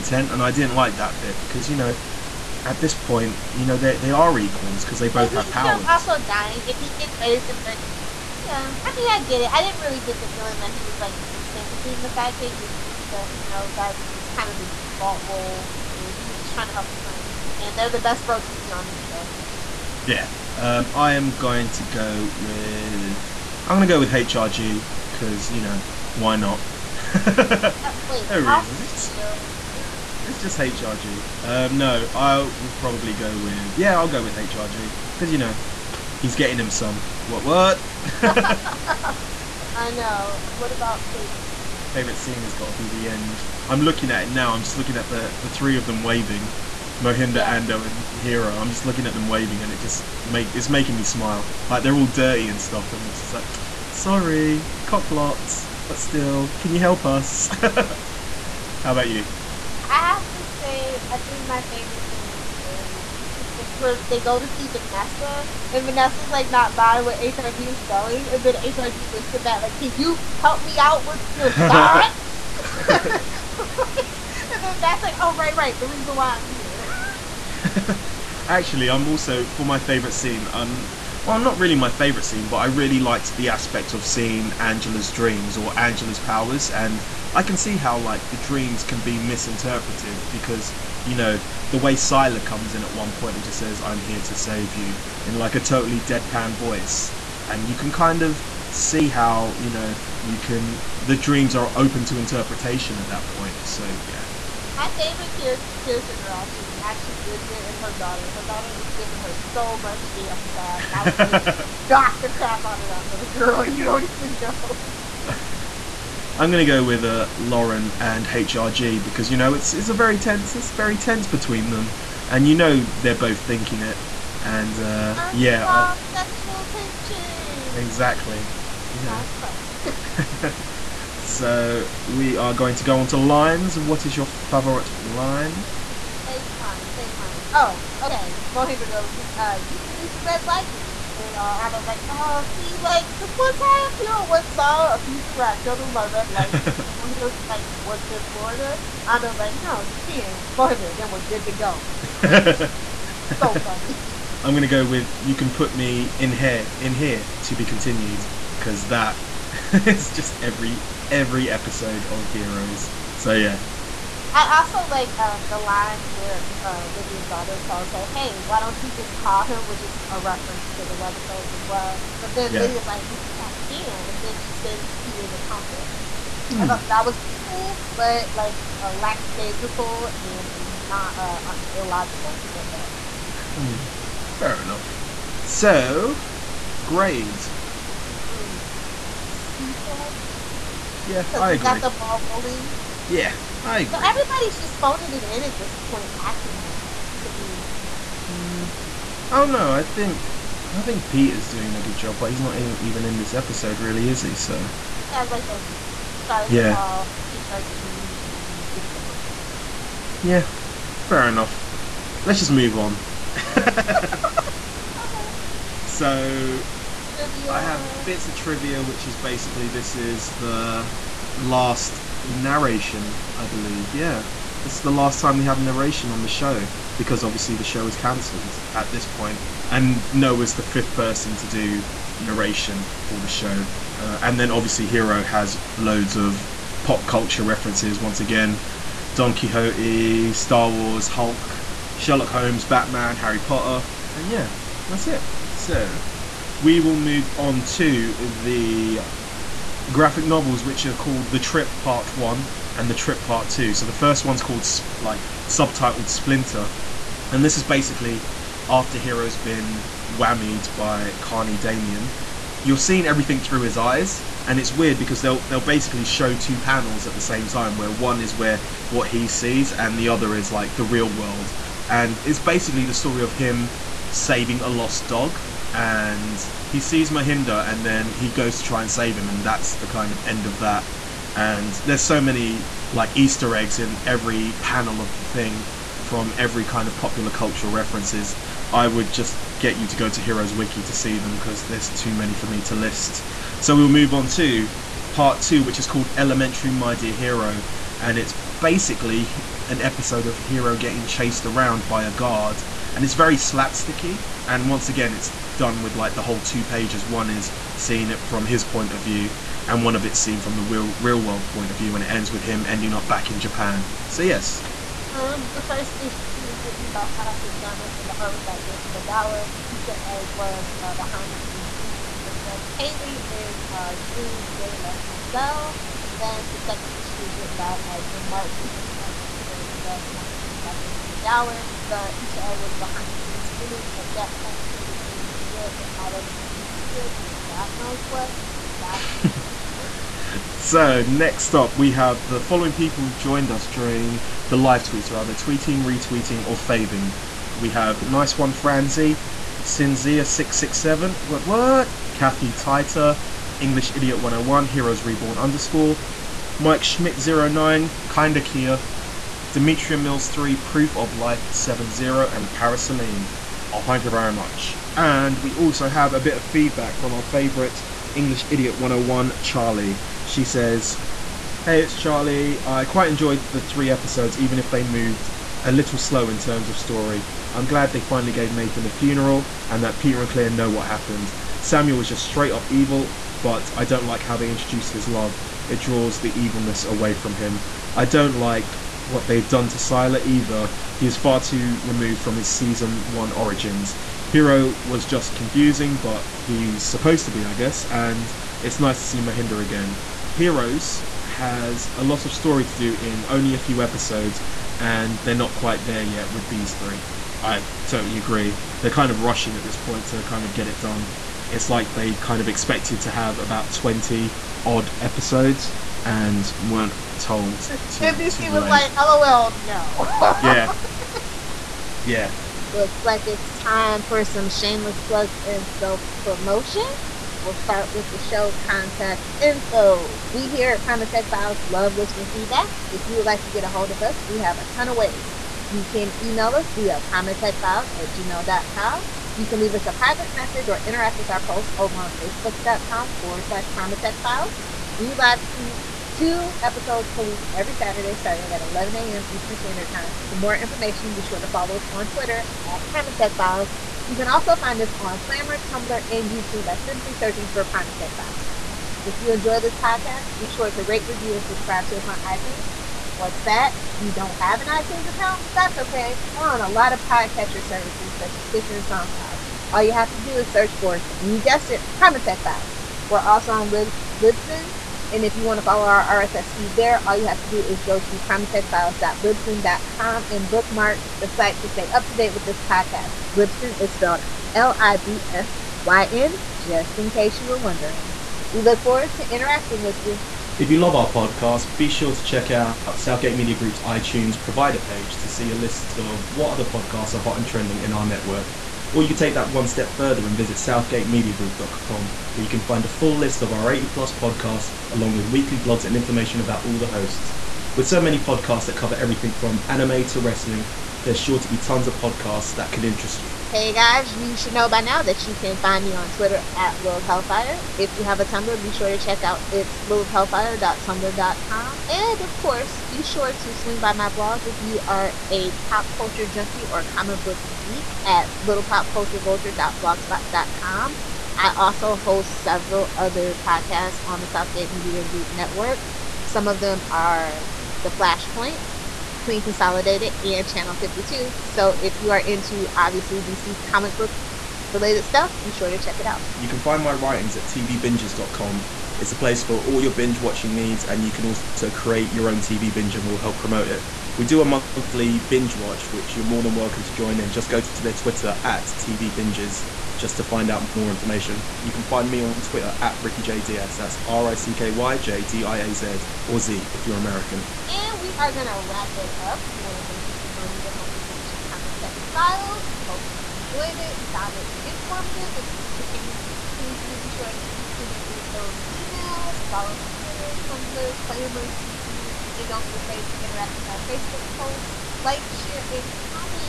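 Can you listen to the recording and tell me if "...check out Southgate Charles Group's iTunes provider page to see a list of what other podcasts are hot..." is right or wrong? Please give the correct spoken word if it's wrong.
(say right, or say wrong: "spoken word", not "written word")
wrong: "Media", not "Charles".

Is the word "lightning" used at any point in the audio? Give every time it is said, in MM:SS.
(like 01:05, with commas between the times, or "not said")
02:20, 02:26.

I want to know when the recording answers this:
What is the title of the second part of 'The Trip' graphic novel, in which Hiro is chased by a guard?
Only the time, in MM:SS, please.
04:56.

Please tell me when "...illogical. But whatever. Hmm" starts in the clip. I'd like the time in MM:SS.
03:01.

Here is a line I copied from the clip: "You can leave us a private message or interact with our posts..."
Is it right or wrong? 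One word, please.
right.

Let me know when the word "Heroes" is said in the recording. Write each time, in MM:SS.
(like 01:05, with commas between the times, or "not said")
02:42, 04:50, 05:54, 06:40.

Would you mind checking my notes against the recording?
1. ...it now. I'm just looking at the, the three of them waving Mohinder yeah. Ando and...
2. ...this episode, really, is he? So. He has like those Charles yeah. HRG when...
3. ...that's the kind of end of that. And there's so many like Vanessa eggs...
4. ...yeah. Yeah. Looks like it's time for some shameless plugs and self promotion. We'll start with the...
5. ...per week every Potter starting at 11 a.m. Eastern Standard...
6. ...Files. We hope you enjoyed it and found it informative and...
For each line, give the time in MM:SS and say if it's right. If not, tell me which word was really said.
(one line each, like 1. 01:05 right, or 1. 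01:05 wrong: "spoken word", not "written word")
1. 00:44 right
2. 03:23 right
3. 04:39 wrong: "Easter", not "Vanessa"
4. 07:00 right
5. 07:27 wrong: "Saturday", not "Potter"
6. 09:32 right.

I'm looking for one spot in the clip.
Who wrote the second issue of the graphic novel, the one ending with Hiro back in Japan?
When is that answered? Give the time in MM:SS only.
05:28.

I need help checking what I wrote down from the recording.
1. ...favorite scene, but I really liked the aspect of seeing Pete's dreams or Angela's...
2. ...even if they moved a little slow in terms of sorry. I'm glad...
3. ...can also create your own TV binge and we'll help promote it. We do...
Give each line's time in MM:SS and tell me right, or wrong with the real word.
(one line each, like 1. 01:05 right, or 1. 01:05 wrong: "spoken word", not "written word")
1. 01:21 wrong: "Angela", not "Pete"
2. 06:14 wrong: "story", not "sorry"
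3. 09:11 right.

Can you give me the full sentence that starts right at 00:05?
also dying, and he's getting ready to marry yeah, I mean, I get it.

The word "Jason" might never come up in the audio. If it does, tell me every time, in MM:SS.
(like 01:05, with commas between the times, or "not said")
05:18, 05:30.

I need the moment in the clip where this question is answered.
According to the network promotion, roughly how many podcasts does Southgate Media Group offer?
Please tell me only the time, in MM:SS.
08:23.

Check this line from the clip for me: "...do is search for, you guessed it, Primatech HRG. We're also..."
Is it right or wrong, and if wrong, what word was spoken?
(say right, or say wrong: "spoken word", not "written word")
wrong: "Files", not "HRG".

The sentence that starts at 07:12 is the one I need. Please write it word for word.
If you would like to get a hold of us, we have a ton of ways.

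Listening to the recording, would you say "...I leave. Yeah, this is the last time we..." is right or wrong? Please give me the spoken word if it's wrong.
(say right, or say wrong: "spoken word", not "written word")
wrong: "believe", not "leave".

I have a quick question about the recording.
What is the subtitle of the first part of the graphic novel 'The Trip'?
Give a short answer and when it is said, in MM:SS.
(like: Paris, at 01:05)
Splinter, at 04:16.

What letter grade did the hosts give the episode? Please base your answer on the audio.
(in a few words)
C plus.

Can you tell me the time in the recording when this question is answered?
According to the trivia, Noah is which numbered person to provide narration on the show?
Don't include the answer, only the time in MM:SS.
03:50.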